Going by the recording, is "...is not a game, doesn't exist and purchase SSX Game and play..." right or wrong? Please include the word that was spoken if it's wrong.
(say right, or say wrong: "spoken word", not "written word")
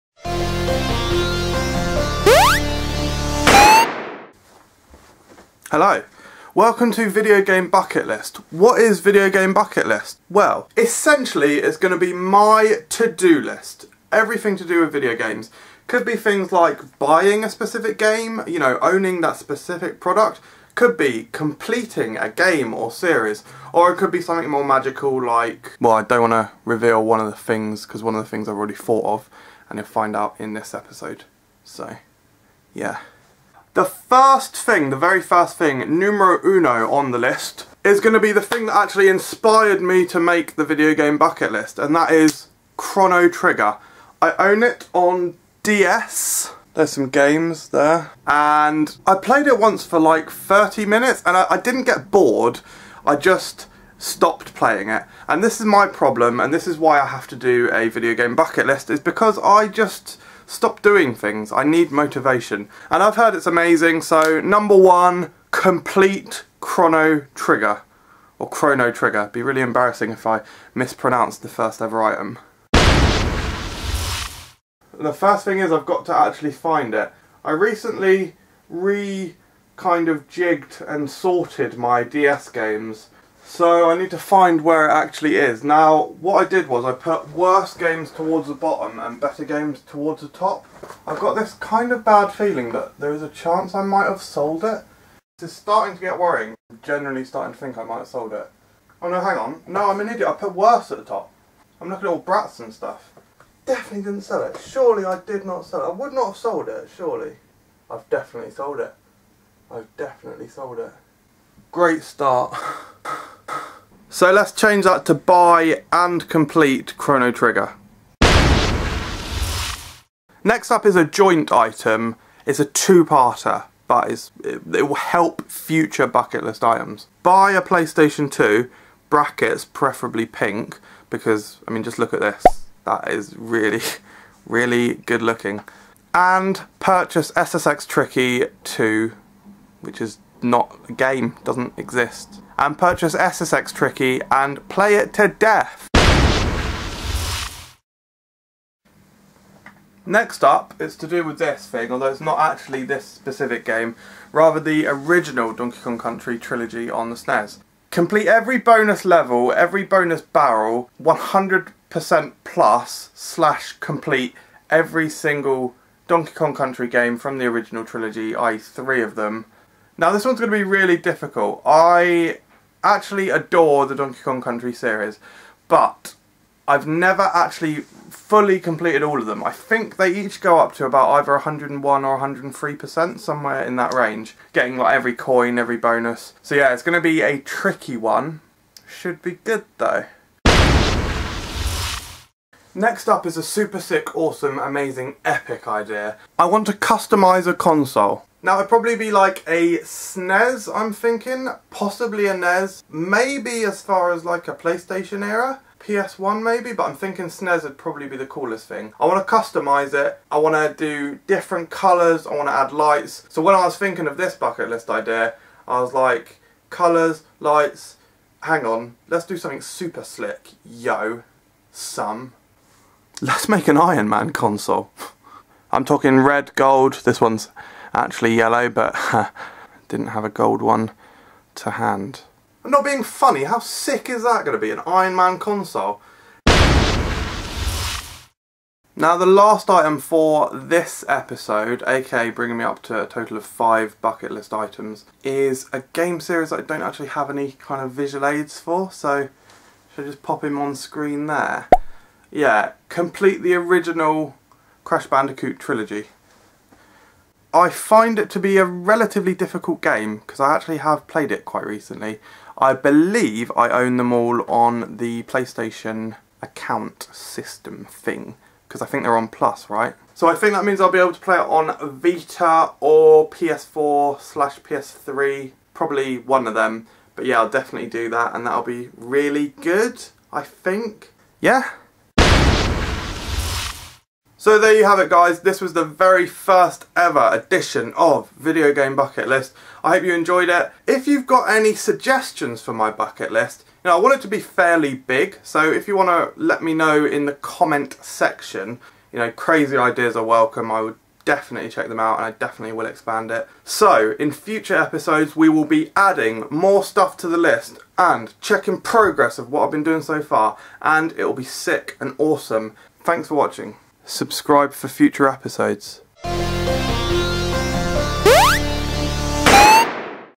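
wrong: "Tricky", not "Game".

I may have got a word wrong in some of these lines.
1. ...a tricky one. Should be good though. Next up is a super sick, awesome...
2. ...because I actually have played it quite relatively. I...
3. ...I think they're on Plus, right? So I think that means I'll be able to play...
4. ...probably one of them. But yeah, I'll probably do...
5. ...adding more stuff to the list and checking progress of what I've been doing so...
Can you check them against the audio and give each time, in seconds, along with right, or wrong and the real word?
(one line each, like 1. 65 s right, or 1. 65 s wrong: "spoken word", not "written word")
1. 187 s right
2. 260 s wrong: "recently", not "relatively"
3. 268 s right
4. 275 s wrong: "definitely", not "probably"
5. 305 s right.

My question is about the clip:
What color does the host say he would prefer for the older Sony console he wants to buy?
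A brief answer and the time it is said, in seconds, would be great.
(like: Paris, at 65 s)
Pink, at 130 s.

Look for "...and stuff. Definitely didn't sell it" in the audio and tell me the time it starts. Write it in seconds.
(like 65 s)
102 s.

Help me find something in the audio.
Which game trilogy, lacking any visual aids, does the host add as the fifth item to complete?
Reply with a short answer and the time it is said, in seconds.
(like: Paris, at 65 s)
Crash Bandicoot, at 254 s.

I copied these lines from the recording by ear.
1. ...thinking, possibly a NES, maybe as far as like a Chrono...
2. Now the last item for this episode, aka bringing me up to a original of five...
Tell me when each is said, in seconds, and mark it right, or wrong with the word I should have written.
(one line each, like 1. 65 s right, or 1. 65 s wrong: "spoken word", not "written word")
1. 200 s wrong: "PlayStation", not "Chrono"
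2. 238 s wrong: "total", not "original".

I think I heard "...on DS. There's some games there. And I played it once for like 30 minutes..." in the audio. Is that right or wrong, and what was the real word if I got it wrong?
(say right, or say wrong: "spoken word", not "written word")
right.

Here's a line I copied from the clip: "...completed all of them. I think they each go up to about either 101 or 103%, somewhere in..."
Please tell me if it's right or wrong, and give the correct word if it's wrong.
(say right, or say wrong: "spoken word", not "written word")
right.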